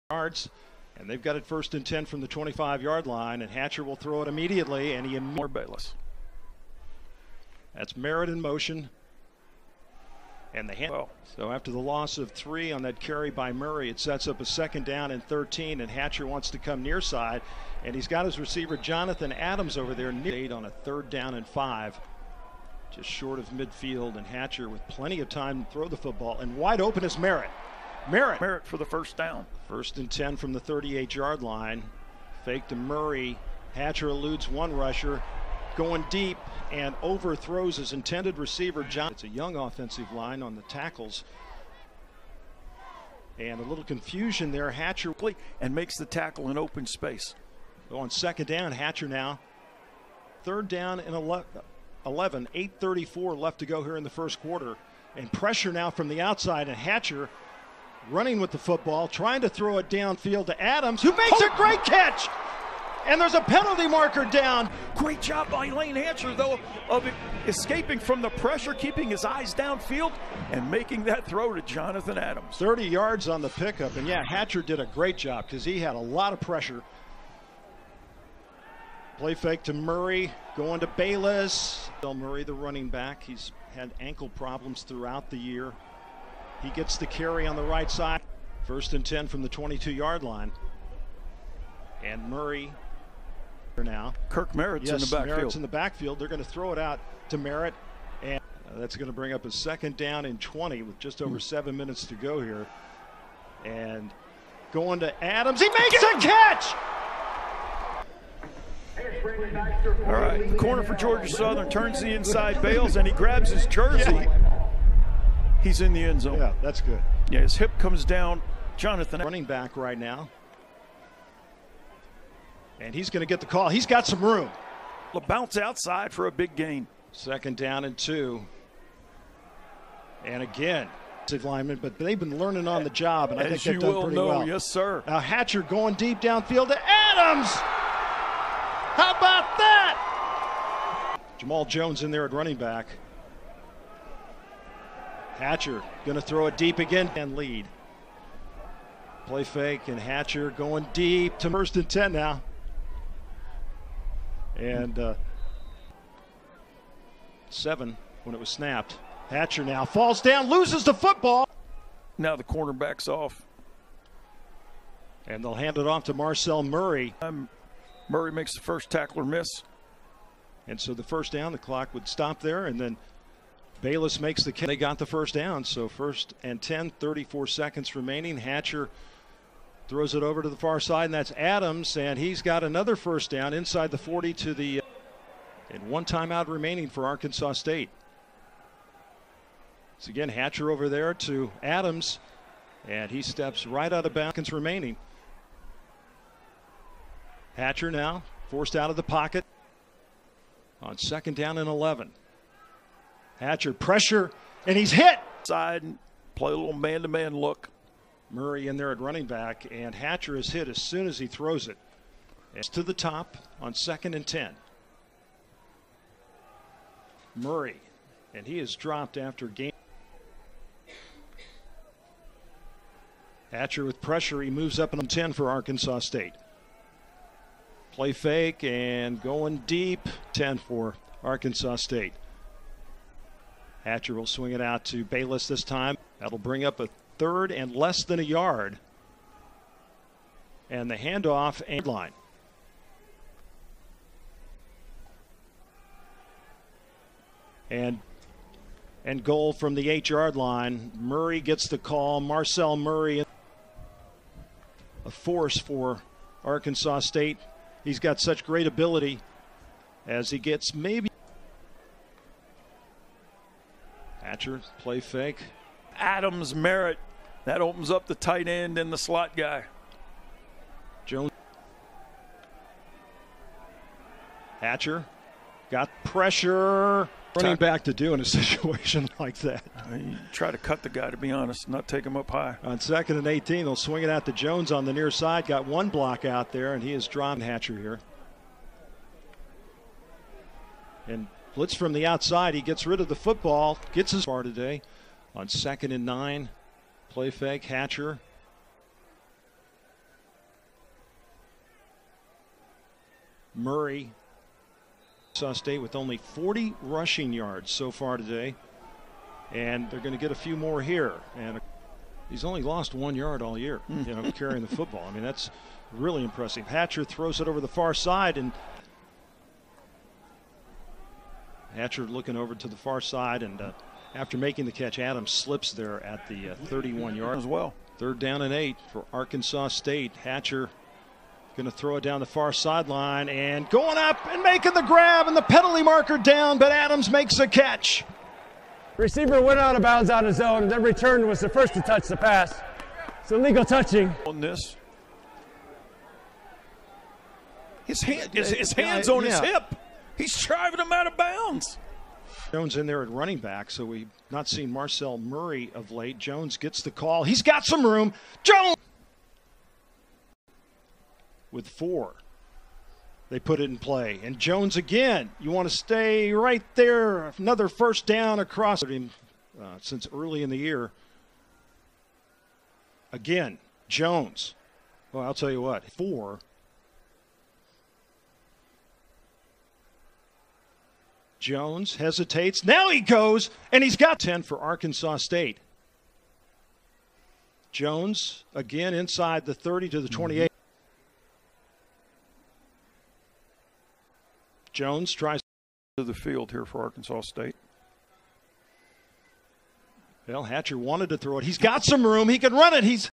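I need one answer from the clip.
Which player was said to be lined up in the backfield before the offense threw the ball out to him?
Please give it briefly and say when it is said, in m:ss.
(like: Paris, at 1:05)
Kirk Merritt, at 1:34.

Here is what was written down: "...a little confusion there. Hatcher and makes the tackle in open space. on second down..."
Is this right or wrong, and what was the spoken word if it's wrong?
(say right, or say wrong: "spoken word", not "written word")
right.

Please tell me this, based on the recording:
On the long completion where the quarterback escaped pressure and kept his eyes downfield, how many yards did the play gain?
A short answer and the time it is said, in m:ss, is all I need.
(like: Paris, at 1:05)
30, at 1:12.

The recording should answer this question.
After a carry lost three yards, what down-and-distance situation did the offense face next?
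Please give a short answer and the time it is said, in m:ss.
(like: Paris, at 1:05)
Second down and 13, at 0:14.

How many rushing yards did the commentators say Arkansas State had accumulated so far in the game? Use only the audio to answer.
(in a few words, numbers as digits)
40.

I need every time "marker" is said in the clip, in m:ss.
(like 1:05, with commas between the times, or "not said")
1:03, 5:35.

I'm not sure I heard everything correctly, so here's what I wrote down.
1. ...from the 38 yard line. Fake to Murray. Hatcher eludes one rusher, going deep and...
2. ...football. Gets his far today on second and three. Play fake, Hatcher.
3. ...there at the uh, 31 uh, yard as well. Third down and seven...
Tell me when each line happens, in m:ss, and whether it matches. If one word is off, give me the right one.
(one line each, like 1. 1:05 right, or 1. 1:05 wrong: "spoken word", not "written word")
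1. 0:30 right
2. 4:53 wrong: "nine", not "three"
3. 5:25 wrong: "eight", not "seven".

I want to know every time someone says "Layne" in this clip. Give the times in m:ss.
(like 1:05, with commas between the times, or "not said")
1:05.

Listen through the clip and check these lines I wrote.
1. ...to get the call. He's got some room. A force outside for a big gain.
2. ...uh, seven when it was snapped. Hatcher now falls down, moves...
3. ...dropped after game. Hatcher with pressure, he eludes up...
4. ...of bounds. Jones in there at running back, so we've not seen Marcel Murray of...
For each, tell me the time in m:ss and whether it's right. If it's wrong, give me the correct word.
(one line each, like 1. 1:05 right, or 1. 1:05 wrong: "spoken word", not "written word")
1. 2:03 wrong: "bounce", not "force"
2. 2:34 wrong: "loses", not "moves"
3. 3:38 wrong: "moves", not "eludes"
4. 5:51 right.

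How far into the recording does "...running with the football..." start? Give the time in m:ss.
0:58.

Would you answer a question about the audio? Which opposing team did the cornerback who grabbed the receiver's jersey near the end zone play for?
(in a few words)
Georgia Southern.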